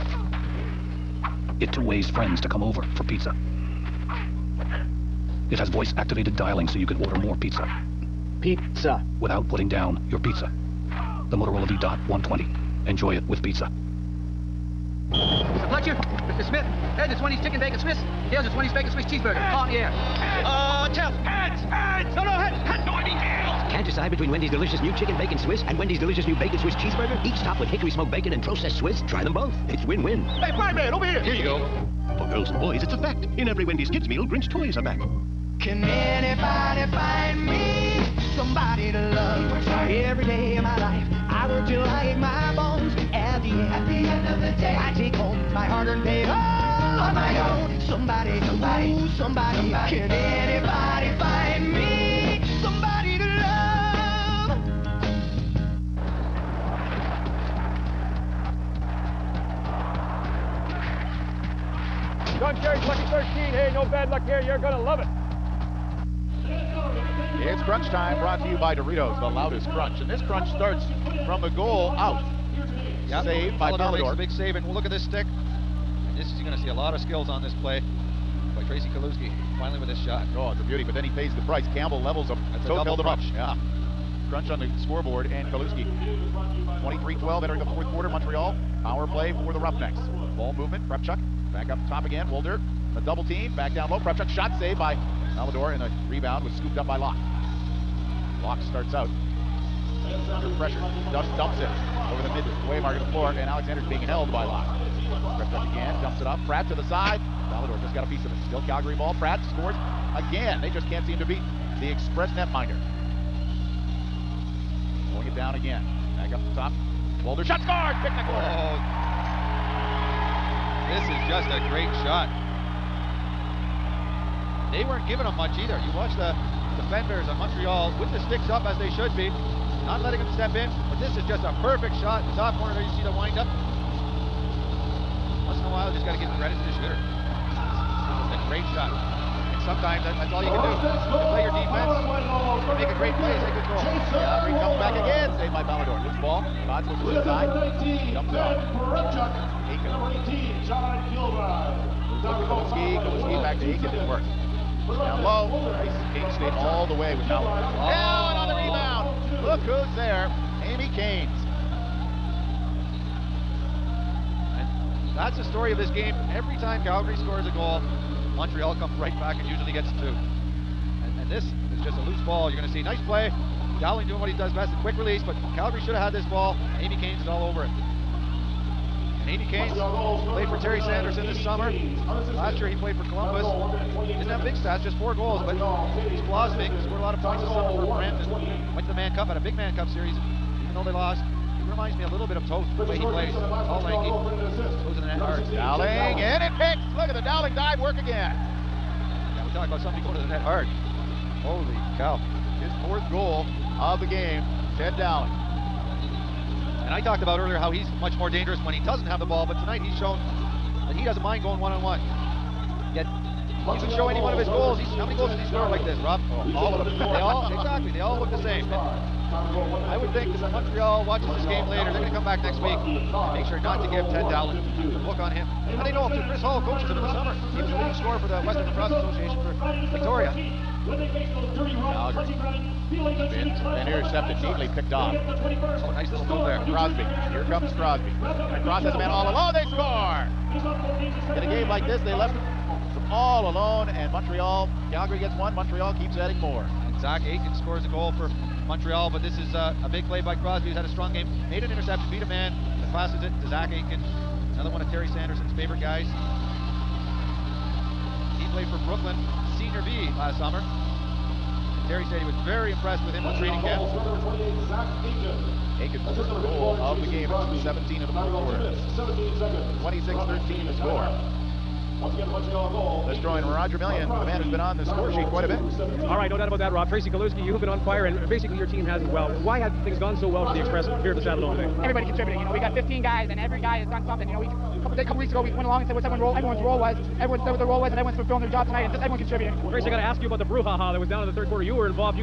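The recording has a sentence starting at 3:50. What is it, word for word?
When they face those dirty runs, running and intercepted, neatly picked off.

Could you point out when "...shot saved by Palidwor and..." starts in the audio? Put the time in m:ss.
1:34.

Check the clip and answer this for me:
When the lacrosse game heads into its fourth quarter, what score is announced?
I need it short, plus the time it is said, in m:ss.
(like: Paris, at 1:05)
23-12, at 1:26.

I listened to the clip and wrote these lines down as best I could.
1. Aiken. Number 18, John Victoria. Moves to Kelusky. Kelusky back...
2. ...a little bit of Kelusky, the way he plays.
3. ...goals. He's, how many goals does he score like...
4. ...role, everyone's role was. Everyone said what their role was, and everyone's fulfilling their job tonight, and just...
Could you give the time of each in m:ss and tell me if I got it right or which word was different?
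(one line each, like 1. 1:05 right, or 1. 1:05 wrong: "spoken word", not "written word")
1. 2:29 wrong: "Kilbride", not "Victoria"
2. 3:12 wrong: "Toth", not "Kelusky"
3. 3:34 right
4. 4:46 right.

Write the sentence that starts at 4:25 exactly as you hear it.
Aiken's first goal of the game at 2.17 in the fourth quarter.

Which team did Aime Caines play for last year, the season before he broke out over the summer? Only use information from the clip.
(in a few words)
Columbus.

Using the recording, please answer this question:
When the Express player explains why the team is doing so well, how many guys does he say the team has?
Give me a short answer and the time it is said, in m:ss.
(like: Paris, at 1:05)
15, at 4:42.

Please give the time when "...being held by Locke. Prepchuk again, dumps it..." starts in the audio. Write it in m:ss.
1:43.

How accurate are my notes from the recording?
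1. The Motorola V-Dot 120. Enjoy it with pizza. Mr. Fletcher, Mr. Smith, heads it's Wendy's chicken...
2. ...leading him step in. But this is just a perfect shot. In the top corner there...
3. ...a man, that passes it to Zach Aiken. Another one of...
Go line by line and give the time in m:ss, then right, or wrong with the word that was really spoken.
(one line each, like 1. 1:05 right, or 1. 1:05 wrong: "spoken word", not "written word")
1. 0:11 right
2. 2:09 wrong: "letting", not "leading"
3. 4:12 right.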